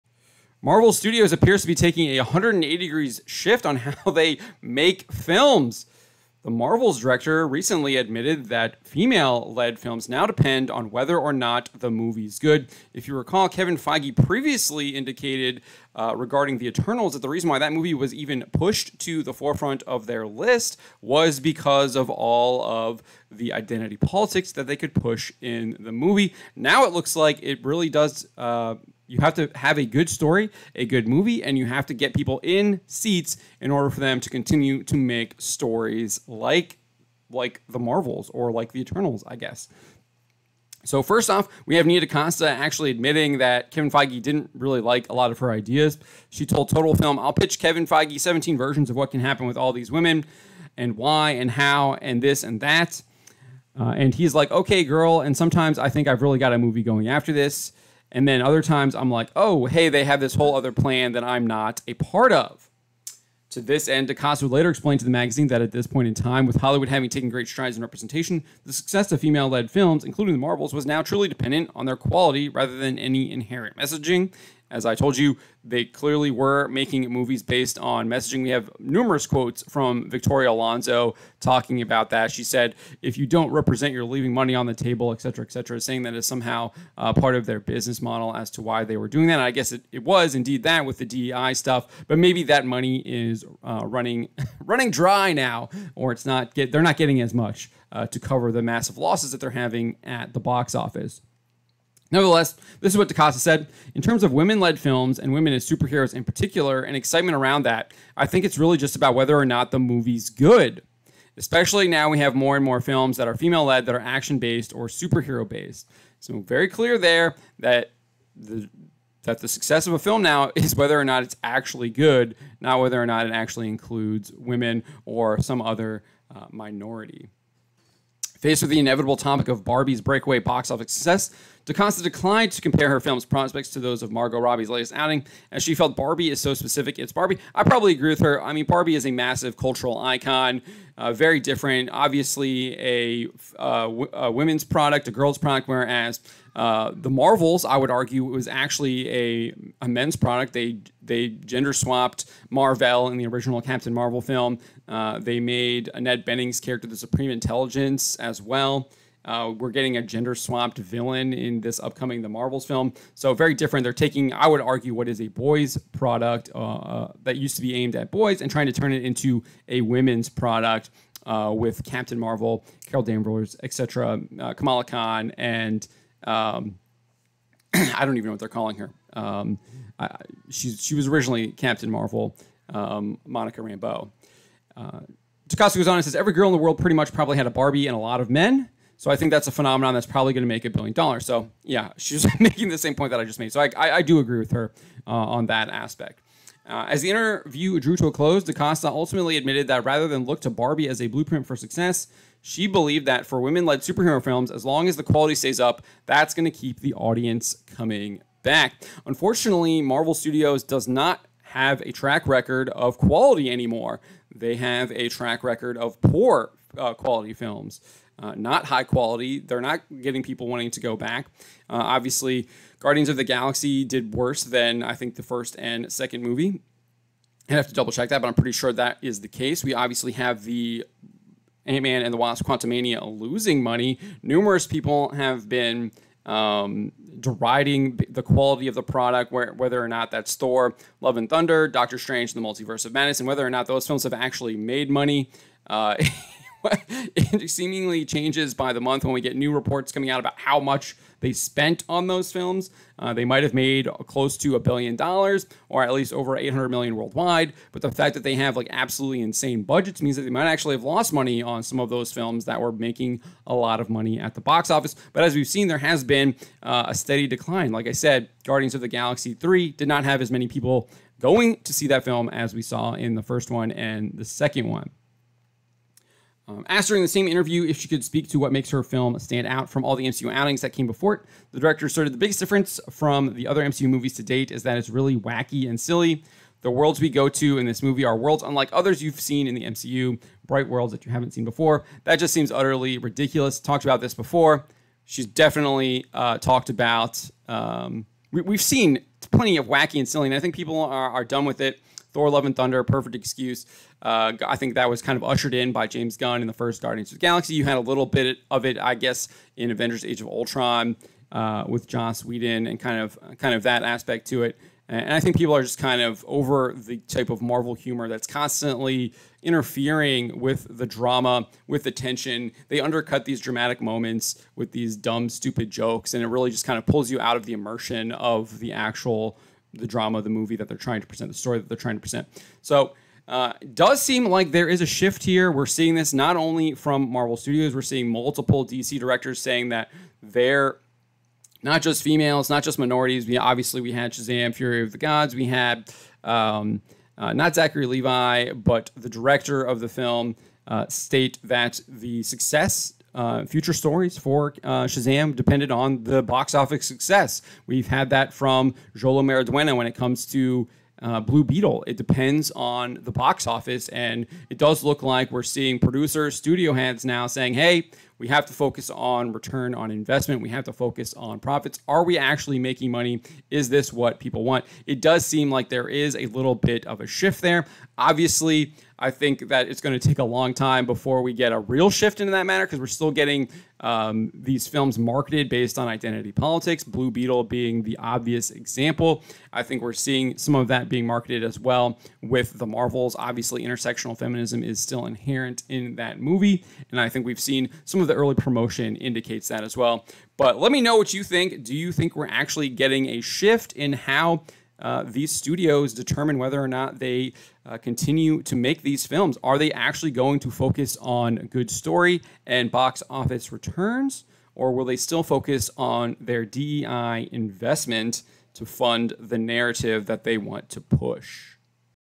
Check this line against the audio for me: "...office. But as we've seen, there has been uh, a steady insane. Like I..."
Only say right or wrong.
wrong.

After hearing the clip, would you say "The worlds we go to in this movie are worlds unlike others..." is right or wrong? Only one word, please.
right.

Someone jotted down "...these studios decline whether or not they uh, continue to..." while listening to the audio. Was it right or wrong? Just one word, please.
wrong.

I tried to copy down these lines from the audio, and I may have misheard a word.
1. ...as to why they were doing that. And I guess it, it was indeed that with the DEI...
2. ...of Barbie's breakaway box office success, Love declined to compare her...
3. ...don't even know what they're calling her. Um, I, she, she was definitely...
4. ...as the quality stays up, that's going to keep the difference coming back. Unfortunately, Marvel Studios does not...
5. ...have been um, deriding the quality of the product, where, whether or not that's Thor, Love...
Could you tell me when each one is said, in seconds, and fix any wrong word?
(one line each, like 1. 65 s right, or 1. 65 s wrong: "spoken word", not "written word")
1. 88 s right
2. 129 s wrong: "DaCosta", not "Love"
3. 178 s wrong: "originally", not "definitely"
4. 204 s wrong: "audience", not "difference"
5. 235 s right.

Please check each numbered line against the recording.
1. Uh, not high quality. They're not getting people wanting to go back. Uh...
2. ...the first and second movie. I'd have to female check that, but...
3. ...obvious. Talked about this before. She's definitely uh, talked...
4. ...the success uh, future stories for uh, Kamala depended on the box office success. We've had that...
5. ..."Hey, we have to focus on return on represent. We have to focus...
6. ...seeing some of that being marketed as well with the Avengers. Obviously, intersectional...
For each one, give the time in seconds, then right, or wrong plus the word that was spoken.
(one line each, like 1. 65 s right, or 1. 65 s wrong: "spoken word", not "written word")
1. 218 s right
2. 225 s wrong: "double", not "female"
3. 292 s wrong: "ridiculous", not "obvious"
4. 351 s wrong: "Shazam", not "Kamala"
5. 367 s wrong: "investment", not "represent"
6. 389 s wrong: "Marvels", not "Avengers".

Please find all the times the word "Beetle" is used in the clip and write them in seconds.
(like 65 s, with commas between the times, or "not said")
361 s, 387 s.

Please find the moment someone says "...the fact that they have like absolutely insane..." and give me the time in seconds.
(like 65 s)
257 s.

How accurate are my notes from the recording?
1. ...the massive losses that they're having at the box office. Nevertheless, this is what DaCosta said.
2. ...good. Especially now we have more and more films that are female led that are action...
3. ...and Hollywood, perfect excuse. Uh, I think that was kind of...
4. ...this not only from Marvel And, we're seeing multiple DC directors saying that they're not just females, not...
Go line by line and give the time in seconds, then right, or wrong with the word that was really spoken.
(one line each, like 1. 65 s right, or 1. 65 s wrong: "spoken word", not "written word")
1. 98 s right
2. 110 s right
3. 302 s wrong: "Thunder", not "Hollywood"
4. 335 s wrong: "Studios", not "And".